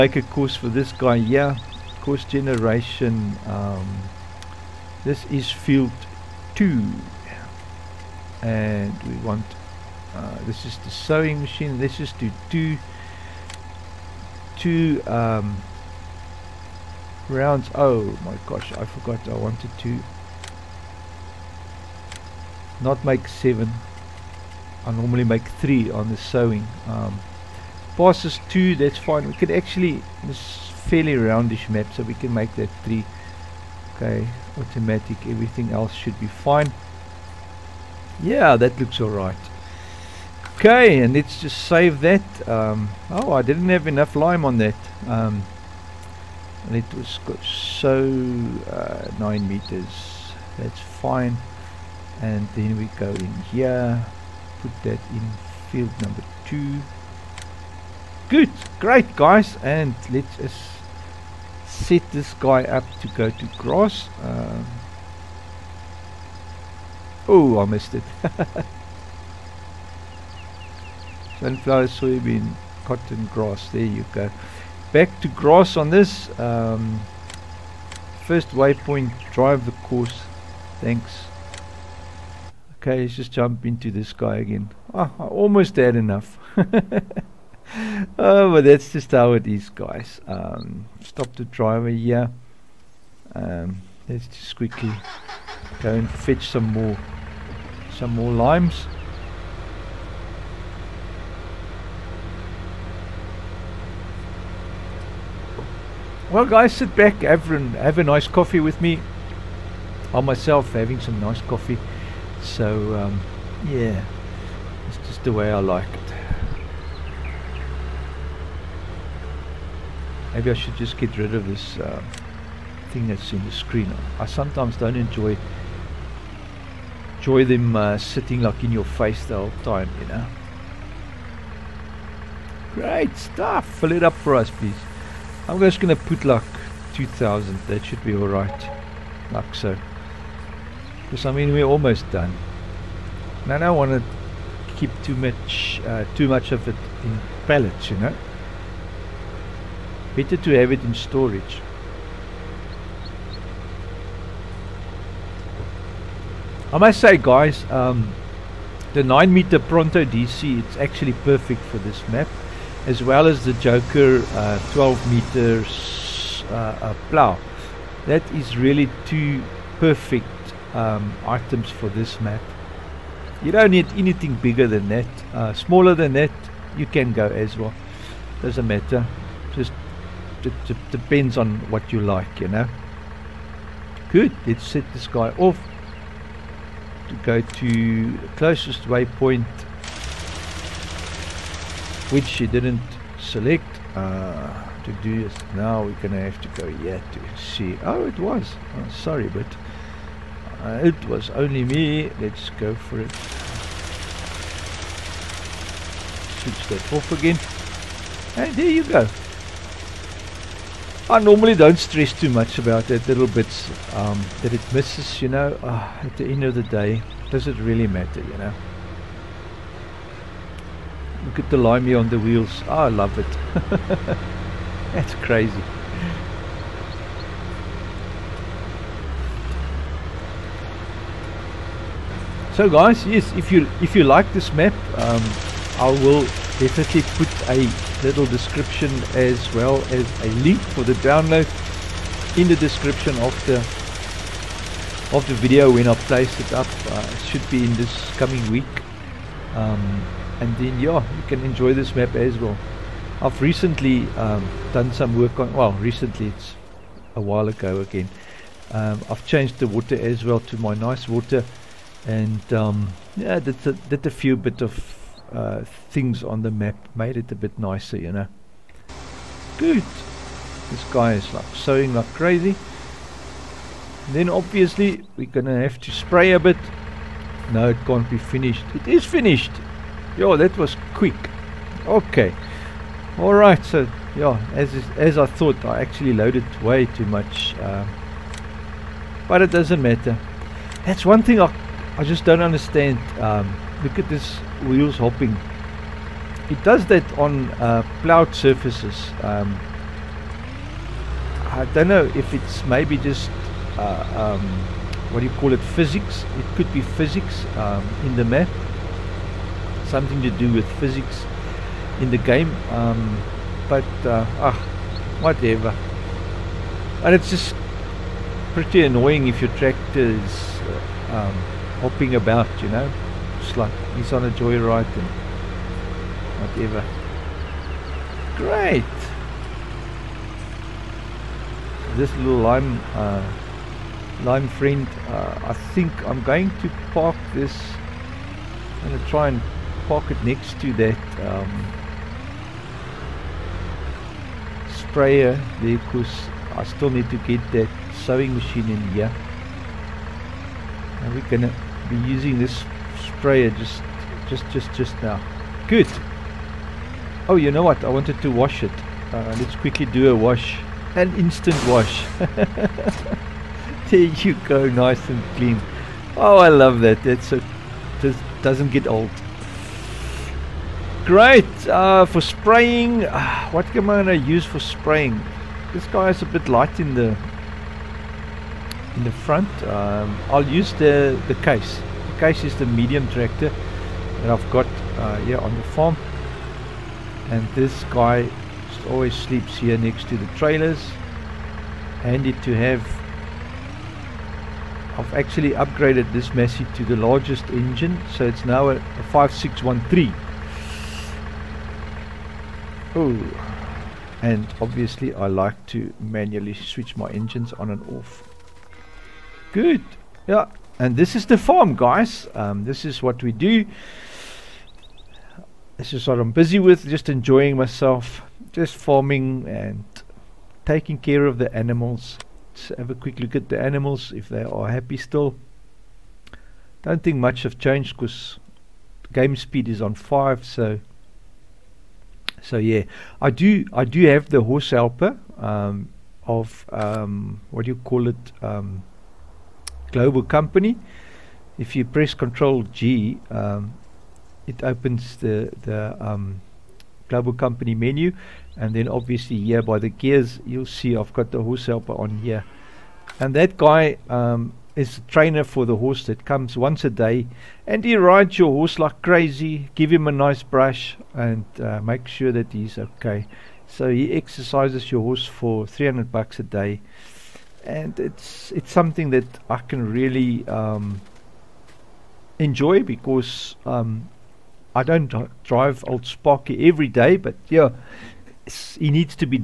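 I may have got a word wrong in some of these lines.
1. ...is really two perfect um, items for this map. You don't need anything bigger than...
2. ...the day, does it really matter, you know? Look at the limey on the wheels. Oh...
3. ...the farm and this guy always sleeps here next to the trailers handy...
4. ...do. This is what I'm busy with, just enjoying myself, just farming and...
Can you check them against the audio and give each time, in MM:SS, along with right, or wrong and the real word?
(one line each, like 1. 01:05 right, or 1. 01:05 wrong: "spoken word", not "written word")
1. 02:48 right
2. 03:36 right
3. 06:25 right
4. 06:53 right.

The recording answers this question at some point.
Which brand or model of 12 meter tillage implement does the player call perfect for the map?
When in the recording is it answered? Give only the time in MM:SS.
02:43.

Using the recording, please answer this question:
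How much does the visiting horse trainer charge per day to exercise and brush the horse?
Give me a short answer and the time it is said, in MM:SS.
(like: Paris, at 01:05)
300 bucks, at 07:45.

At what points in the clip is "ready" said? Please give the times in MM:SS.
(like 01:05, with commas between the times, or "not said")
not said.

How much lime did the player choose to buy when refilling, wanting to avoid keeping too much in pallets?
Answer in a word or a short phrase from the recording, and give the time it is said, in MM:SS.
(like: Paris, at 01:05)
2,000, at 02:16.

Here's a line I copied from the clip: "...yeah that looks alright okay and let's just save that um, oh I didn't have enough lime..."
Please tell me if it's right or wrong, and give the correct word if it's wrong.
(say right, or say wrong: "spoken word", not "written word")
right.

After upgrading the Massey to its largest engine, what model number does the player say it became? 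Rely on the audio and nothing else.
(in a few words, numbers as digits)
5613.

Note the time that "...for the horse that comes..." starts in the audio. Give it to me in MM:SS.
07:35.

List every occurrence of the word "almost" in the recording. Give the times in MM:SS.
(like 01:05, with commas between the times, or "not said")
01:25, 02:21.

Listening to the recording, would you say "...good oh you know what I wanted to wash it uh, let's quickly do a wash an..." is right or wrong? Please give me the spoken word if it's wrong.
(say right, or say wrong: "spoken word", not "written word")
right.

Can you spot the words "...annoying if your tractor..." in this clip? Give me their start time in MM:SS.
05:18.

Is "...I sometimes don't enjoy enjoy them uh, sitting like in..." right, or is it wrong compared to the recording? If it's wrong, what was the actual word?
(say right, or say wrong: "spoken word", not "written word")
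right.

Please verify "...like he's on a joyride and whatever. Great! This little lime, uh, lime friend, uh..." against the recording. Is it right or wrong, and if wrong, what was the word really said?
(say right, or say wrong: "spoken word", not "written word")
right.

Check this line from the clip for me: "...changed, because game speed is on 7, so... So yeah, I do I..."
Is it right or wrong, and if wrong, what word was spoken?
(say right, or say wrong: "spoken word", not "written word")
wrong: "5", not "7".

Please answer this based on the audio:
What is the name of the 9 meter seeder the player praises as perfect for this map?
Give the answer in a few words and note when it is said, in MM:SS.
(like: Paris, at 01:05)
Pronto DC, at 02:39.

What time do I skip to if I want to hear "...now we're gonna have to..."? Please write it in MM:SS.
03:15.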